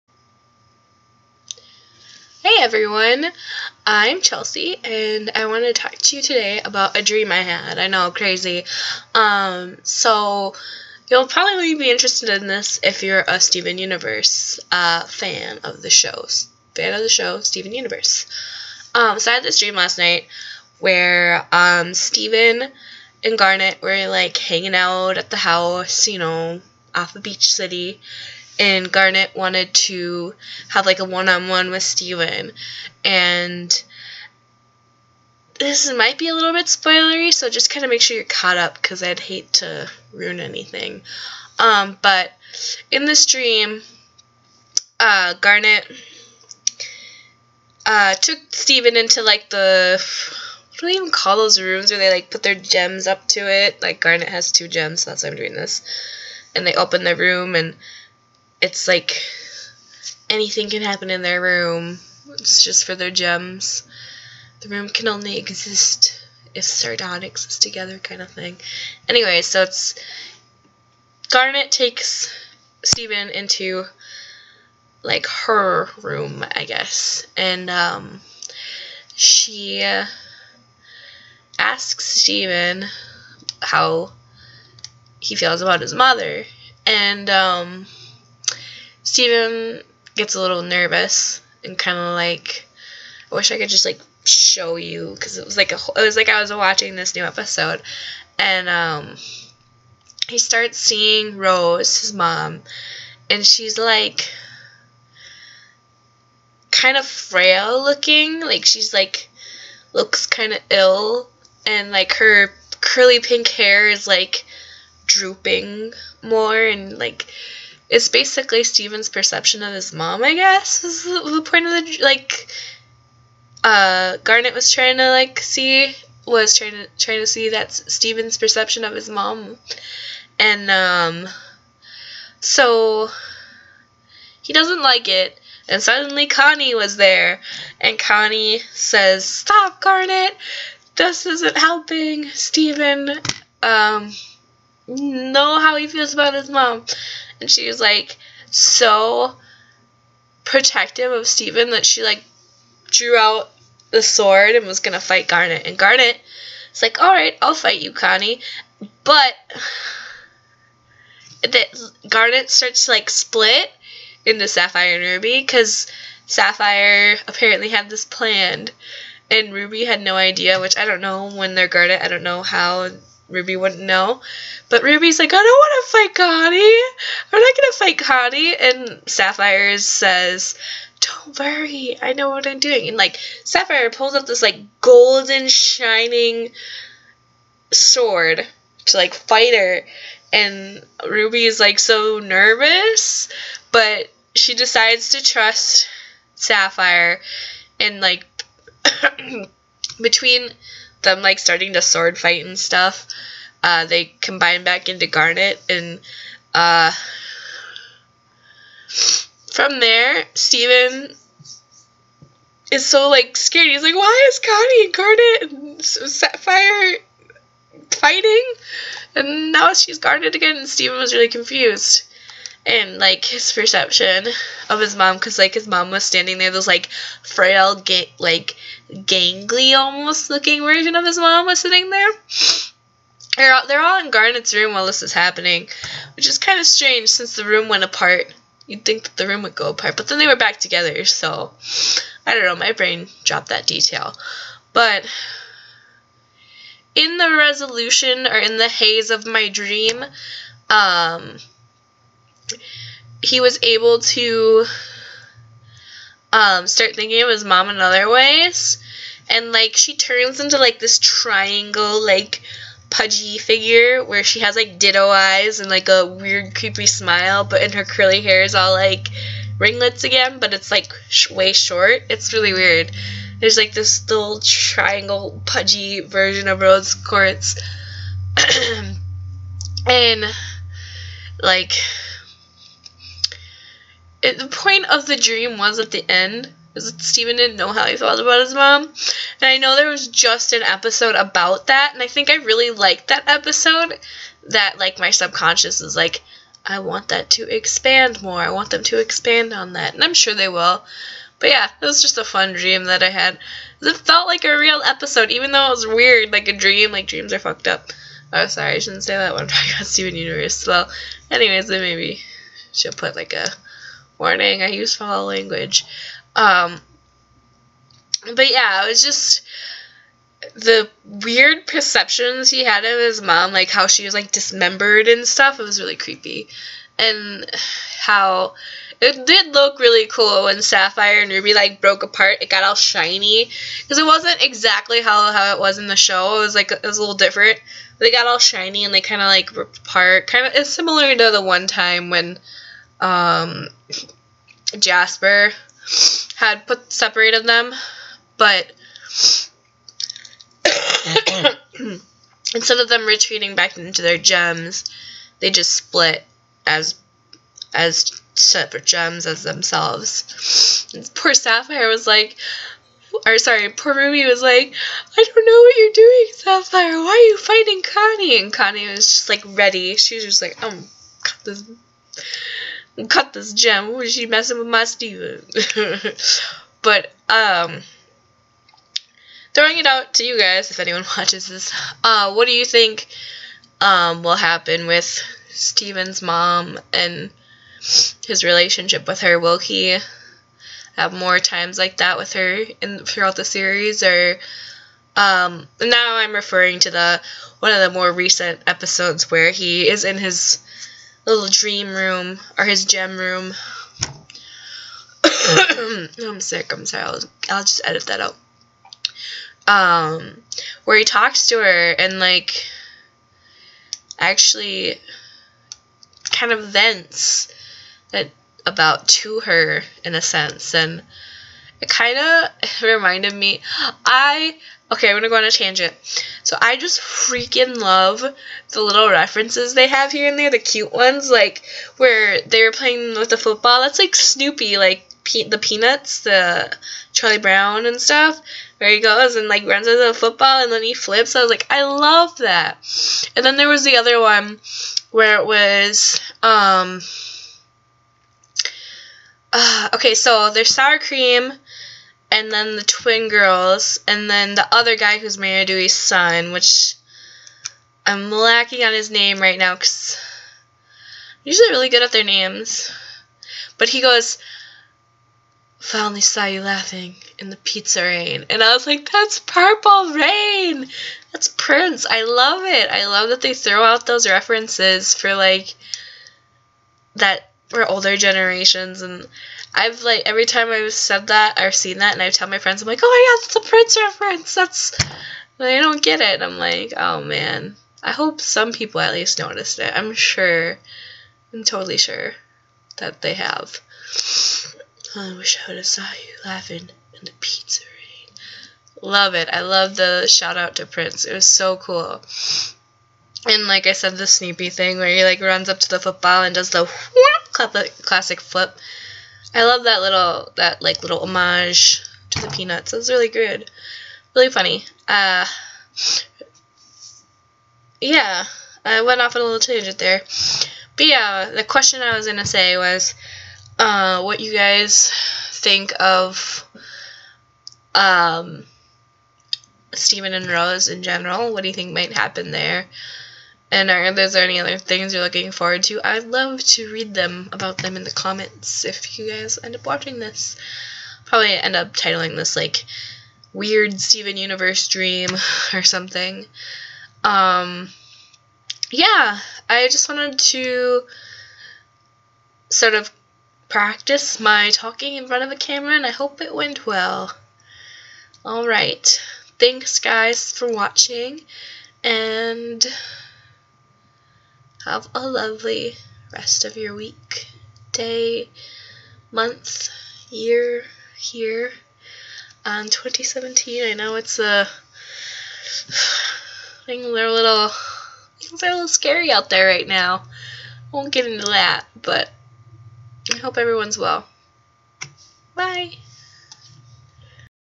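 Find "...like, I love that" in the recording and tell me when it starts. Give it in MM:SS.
07:21.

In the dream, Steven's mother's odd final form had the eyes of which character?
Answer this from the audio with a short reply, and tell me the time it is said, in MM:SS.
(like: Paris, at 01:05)
Ditto, at 04:24.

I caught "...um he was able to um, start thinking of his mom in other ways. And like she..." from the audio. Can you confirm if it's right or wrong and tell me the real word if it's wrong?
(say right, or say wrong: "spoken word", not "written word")
right.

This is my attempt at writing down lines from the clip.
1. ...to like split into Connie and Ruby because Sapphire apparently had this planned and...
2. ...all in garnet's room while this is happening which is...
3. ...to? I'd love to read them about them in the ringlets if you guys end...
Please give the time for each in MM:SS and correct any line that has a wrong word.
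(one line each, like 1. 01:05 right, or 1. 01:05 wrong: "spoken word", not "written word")
1. 02:42 wrong: "Sapphire", not "Connie"
2. 03:53 right
3. 08:55 wrong: "comments", not "ringlets".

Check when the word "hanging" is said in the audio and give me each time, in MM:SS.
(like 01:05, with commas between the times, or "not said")
00:24.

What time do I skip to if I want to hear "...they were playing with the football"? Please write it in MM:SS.
07:12.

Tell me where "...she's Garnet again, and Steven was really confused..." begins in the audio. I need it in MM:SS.
03:39.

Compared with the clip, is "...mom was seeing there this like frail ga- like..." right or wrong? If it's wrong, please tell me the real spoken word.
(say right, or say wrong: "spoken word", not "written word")
wrong: "standing", not "seeing".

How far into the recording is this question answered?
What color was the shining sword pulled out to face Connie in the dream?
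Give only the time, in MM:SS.
03:04.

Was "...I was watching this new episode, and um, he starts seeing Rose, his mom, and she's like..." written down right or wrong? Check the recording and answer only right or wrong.
right.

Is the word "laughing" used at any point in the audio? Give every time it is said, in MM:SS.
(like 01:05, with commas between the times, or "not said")
07:46, 08:16.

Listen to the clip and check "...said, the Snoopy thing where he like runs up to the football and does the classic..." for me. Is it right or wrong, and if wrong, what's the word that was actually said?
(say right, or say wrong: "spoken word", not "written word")
right.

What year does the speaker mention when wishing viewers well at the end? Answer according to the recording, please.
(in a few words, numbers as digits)
2017.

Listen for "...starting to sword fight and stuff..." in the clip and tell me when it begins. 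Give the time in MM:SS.
03:21.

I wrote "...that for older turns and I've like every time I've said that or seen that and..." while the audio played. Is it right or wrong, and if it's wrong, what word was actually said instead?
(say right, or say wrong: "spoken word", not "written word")
wrong: "generations", not "turns".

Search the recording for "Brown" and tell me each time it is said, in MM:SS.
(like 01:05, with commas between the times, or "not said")
07:17.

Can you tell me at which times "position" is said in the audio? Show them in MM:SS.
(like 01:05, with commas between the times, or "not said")
not said.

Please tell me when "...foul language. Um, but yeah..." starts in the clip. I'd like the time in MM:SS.
05:14.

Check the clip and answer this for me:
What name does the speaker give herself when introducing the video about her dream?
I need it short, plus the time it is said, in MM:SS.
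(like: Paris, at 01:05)
Chelsea, at 00:04.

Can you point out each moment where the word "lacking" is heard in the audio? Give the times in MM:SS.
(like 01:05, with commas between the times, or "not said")
07:38.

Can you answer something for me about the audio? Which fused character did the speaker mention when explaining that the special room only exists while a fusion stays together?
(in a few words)
Sardonyx.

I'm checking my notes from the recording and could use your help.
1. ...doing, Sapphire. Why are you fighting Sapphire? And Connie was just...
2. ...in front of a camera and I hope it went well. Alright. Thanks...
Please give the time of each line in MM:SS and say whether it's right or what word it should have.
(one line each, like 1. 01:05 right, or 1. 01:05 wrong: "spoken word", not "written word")
1. 06:05 wrong: "Connie", not "Sapphire"
2. 09:15 right.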